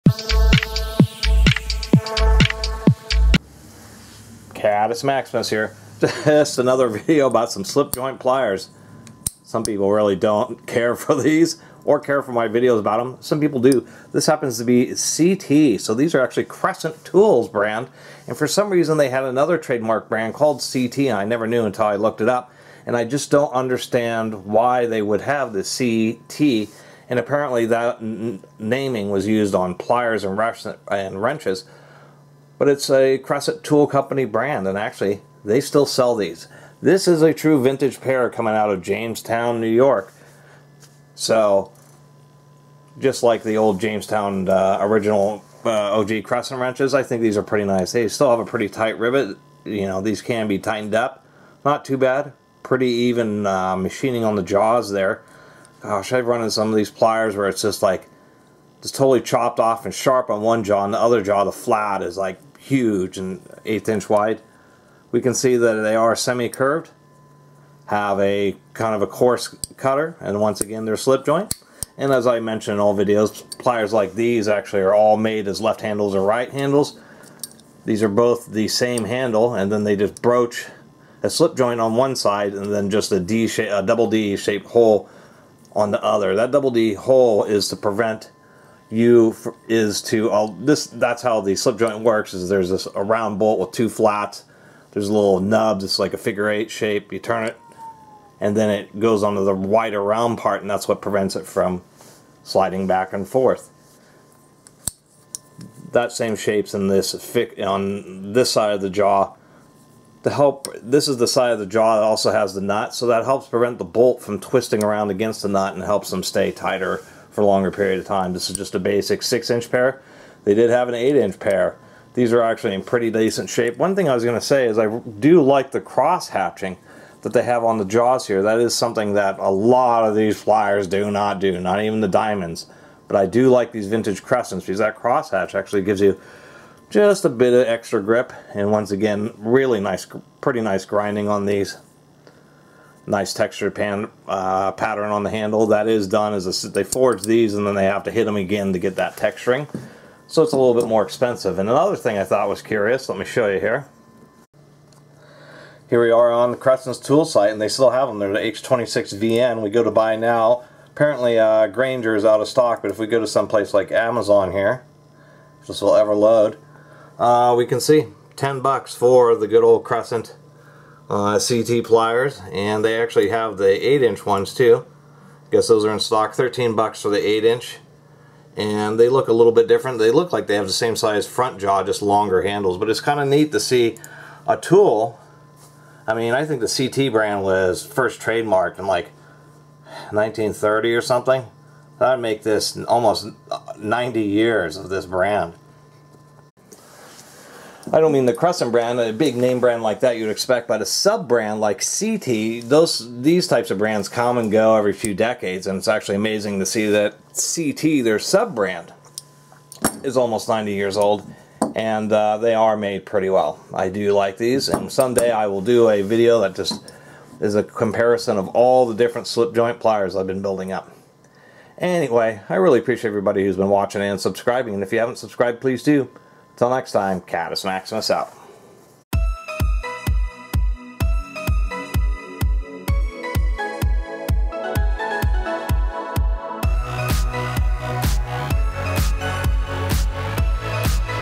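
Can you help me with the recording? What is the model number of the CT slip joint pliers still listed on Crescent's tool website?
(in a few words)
H26VN.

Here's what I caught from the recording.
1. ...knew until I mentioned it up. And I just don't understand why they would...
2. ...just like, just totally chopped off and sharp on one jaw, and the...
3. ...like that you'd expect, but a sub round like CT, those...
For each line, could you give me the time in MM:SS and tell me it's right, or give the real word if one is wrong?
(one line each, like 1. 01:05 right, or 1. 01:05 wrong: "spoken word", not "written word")
1. 00:21 wrong: "looked", not "mentioned"
2. 00:57 right
3. 03:19 wrong: "brand", not "round".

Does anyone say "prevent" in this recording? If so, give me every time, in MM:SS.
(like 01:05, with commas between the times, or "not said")
01:27, 01:41, 01:53.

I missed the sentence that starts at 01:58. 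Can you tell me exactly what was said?
This is just a basic 6-inch pair.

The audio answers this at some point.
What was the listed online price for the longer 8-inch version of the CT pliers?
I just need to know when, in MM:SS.
02:56.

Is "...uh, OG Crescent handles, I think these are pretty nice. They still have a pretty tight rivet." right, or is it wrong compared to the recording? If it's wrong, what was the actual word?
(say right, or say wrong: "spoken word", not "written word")
wrong: "wrenches", not "handles".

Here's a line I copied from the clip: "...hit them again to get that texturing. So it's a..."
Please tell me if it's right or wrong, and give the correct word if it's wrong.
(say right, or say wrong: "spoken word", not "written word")
right.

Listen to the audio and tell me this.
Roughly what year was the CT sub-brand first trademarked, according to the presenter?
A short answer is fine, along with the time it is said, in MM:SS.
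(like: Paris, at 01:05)
1930, at 03:10.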